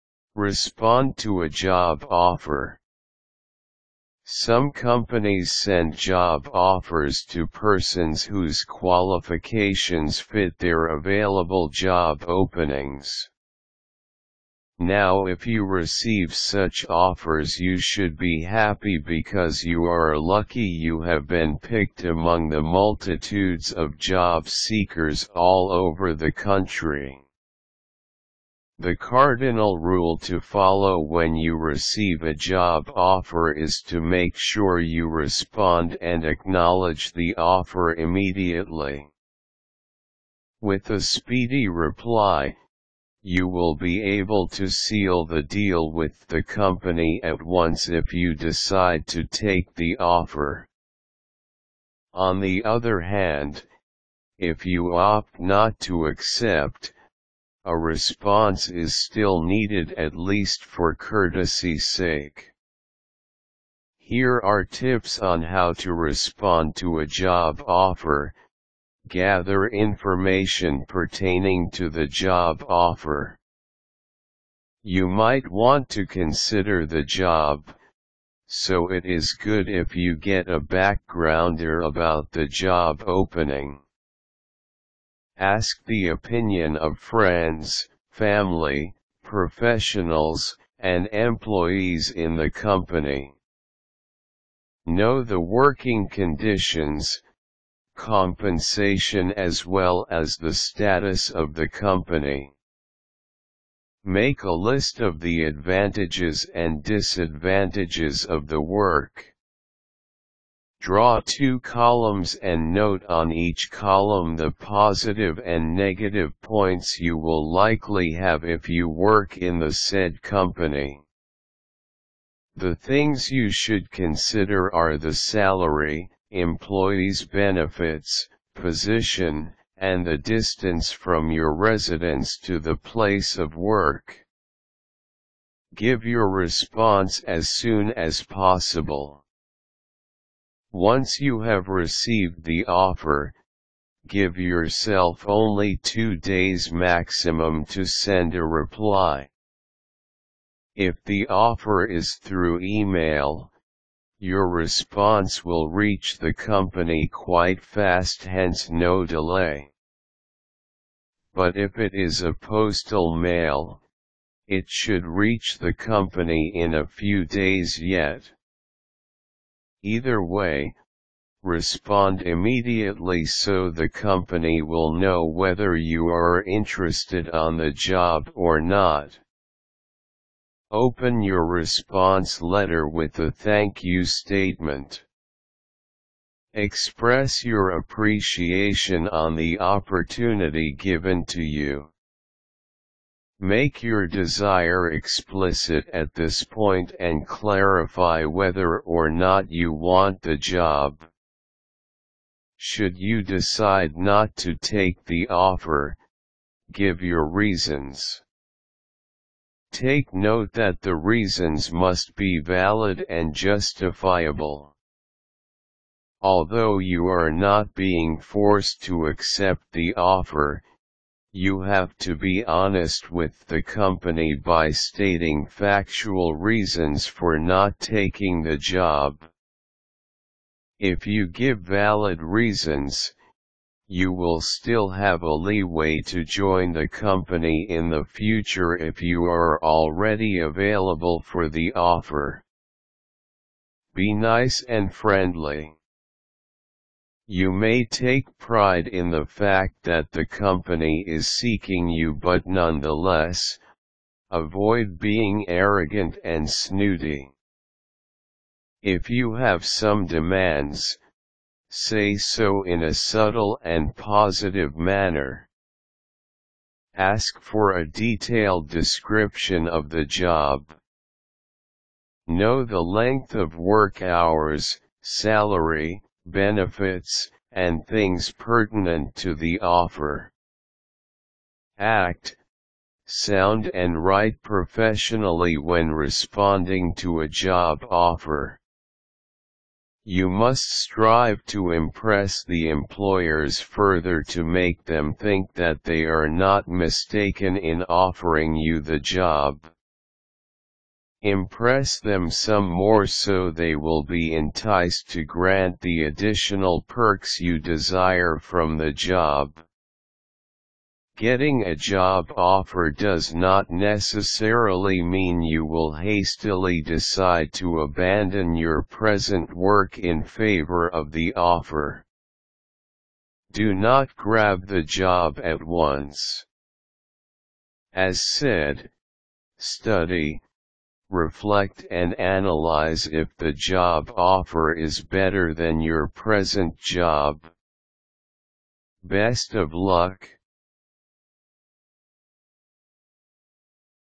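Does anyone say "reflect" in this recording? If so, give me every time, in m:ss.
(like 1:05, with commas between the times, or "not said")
5:31.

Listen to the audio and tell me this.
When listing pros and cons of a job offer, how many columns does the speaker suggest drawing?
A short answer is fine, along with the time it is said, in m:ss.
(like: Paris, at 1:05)
2, at 1:50.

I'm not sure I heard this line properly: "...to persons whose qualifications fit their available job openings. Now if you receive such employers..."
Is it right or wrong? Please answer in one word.
wrong.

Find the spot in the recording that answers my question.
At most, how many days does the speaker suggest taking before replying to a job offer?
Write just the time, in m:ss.
2:25.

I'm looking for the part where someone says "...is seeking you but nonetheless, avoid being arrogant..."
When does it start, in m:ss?
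4:11.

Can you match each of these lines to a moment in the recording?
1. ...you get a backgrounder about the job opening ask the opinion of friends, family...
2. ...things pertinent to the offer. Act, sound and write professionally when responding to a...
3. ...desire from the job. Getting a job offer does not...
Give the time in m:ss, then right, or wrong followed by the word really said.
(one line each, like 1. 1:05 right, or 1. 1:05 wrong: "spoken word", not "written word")
1. 1:19 right
2. 4:37 right
3. 5:07 right.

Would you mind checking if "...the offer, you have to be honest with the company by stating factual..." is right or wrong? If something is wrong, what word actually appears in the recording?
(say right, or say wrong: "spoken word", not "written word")
right.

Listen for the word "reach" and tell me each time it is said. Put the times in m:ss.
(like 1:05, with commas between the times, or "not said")
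2:35, 2:45.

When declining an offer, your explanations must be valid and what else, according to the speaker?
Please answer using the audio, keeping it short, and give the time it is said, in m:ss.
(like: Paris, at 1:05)
Justifiable, at 3:33.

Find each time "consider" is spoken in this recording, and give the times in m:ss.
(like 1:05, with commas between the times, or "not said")
1:16, 2:03.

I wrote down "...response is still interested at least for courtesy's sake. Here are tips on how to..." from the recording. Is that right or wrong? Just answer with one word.
wrong.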